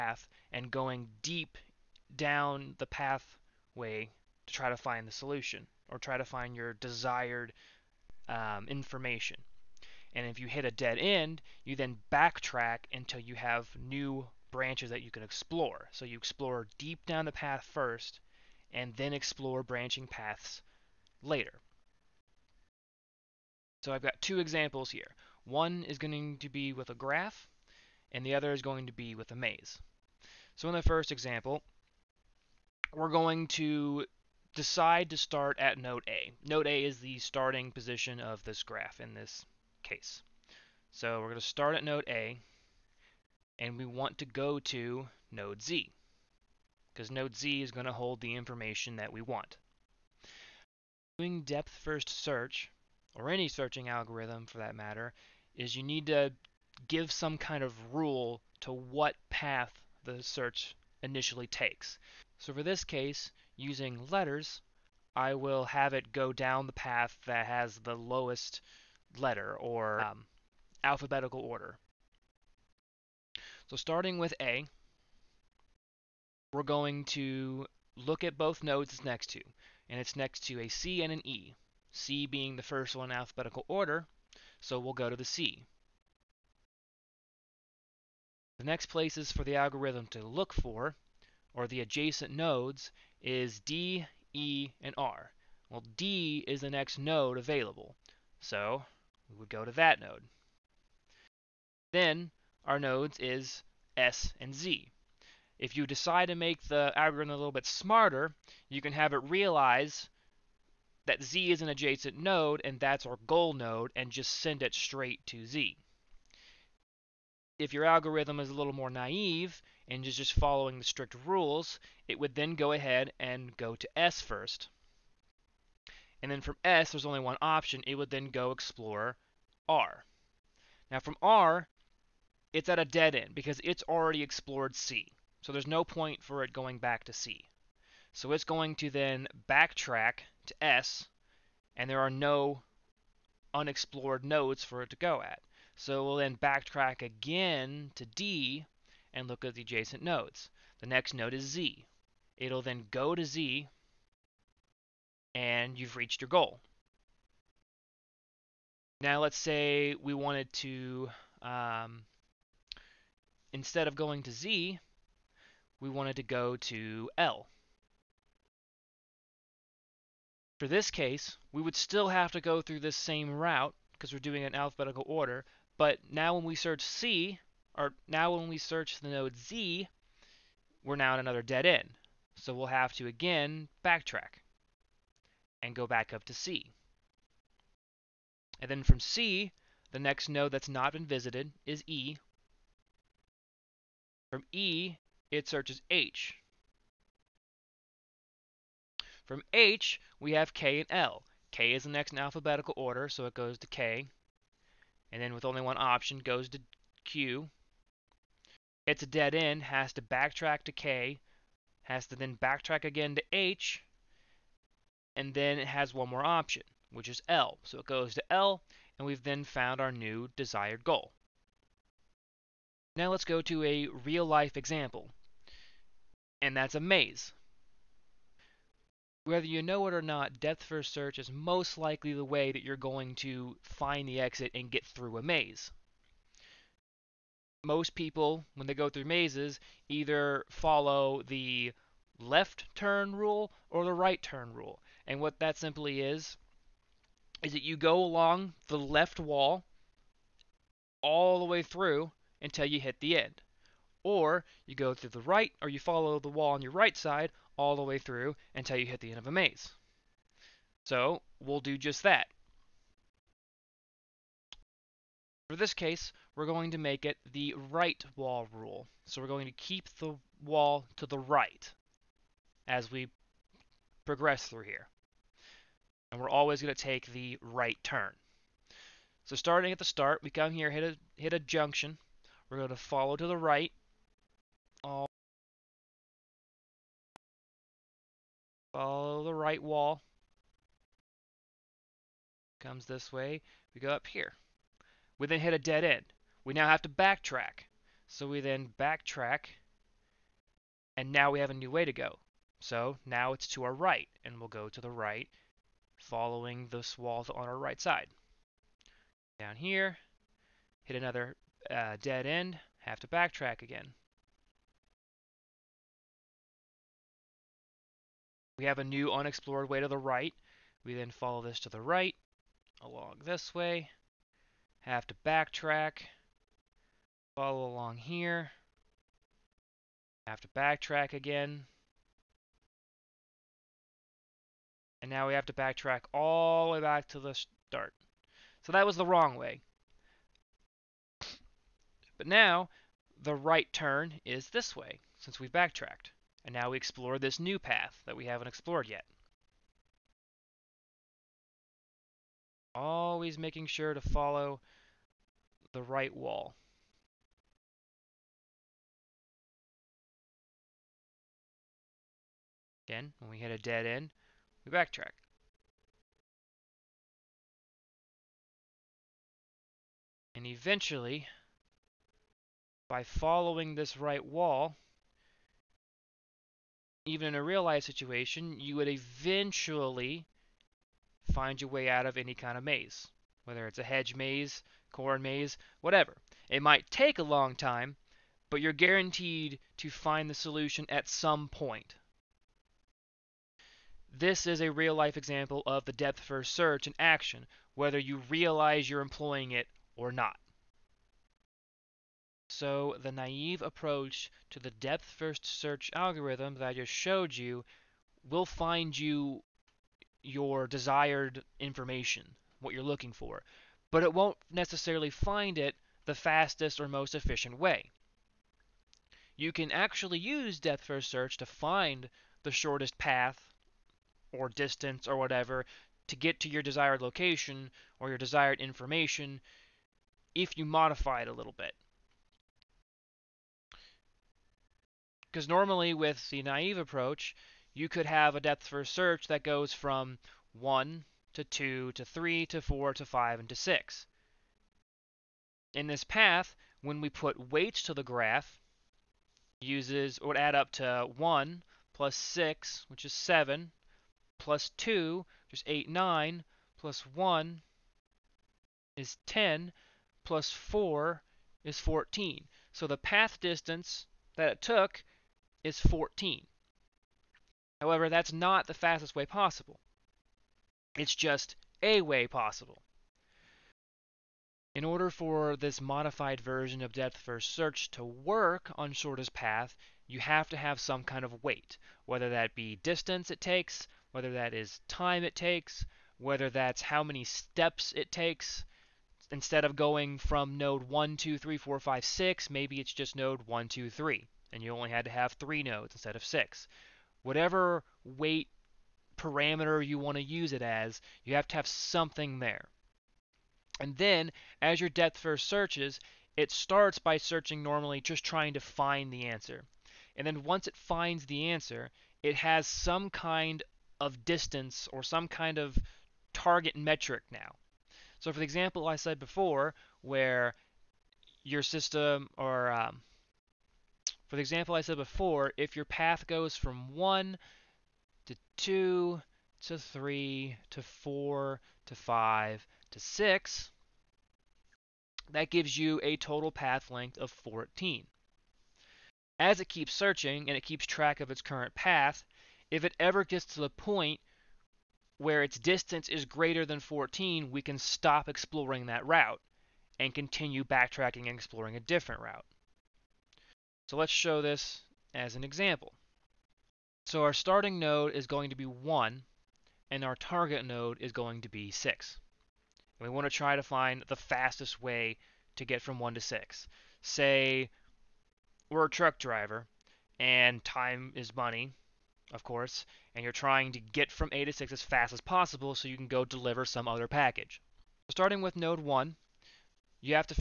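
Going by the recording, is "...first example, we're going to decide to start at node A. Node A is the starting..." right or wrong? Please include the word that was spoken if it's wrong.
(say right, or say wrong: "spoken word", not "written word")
right.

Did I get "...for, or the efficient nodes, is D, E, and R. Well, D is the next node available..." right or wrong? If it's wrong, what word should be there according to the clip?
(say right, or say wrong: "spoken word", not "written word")
wrong: "adjacent", not "efficient".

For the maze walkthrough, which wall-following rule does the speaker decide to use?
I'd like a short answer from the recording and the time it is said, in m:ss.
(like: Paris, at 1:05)
Right wall rule, at 4:27.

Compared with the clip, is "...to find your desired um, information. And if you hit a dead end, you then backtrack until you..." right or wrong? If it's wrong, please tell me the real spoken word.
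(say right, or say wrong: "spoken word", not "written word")
right.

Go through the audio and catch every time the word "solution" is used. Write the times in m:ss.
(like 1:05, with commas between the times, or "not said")
0:05, 6:30.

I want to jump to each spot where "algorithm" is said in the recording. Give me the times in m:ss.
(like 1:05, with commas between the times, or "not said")
0:53, 1:29, 1:46, 1:57, 6:45.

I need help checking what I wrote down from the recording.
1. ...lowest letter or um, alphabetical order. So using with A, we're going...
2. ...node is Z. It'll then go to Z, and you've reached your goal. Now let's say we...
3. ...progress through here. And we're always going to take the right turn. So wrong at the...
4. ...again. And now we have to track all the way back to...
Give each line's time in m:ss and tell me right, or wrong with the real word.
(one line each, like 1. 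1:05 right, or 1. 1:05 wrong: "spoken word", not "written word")
1. 1:07 wrong: "starting", not "using"
2. 2:31 right
3. 4:34 wrong: "starting", not "wrong"
4. 5:31 wrong: "backtrack", not "track".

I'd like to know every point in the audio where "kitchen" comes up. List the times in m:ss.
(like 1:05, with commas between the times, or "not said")
not said.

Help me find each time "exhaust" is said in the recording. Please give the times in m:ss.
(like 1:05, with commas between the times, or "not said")
not said.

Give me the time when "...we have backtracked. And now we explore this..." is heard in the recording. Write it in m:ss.
5:45.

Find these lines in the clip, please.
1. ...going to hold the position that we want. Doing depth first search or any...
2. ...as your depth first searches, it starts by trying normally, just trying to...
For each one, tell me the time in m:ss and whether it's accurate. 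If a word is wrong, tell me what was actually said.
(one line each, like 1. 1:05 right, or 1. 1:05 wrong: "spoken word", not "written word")
1. 0:47 wrong: "information", not "position"
2. 8:24 wrong: "searching", not "trying".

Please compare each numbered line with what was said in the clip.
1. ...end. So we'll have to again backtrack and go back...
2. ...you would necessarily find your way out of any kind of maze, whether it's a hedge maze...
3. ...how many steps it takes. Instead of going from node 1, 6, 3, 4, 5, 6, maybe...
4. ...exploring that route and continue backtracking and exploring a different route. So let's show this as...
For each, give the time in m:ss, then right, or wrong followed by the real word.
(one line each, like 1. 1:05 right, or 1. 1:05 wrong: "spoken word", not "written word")
1. 3:01 right
2. 6:18 wrong: "eventually", not "necessarily"
3. 8:06 wrong: "2", not "6"
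4. 9:08 right.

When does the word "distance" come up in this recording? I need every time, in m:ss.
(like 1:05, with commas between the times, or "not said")
7:04, 7:43, 8:02, 8:34, 9:05.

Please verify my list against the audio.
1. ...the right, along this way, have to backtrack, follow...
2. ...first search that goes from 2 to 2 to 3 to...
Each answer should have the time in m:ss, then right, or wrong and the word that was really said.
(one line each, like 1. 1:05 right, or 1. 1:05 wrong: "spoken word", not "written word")
1. 5:21 right
2. 7:18 wrong: "1", not "2".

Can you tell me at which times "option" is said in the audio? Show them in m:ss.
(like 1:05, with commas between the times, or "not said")
2:07, 3:25, 3:36.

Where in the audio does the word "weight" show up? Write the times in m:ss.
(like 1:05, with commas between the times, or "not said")
7:27, 8:01, 8:18.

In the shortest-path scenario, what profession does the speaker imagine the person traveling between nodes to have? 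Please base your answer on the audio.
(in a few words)
Truck driver.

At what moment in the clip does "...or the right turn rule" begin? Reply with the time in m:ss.
4:03.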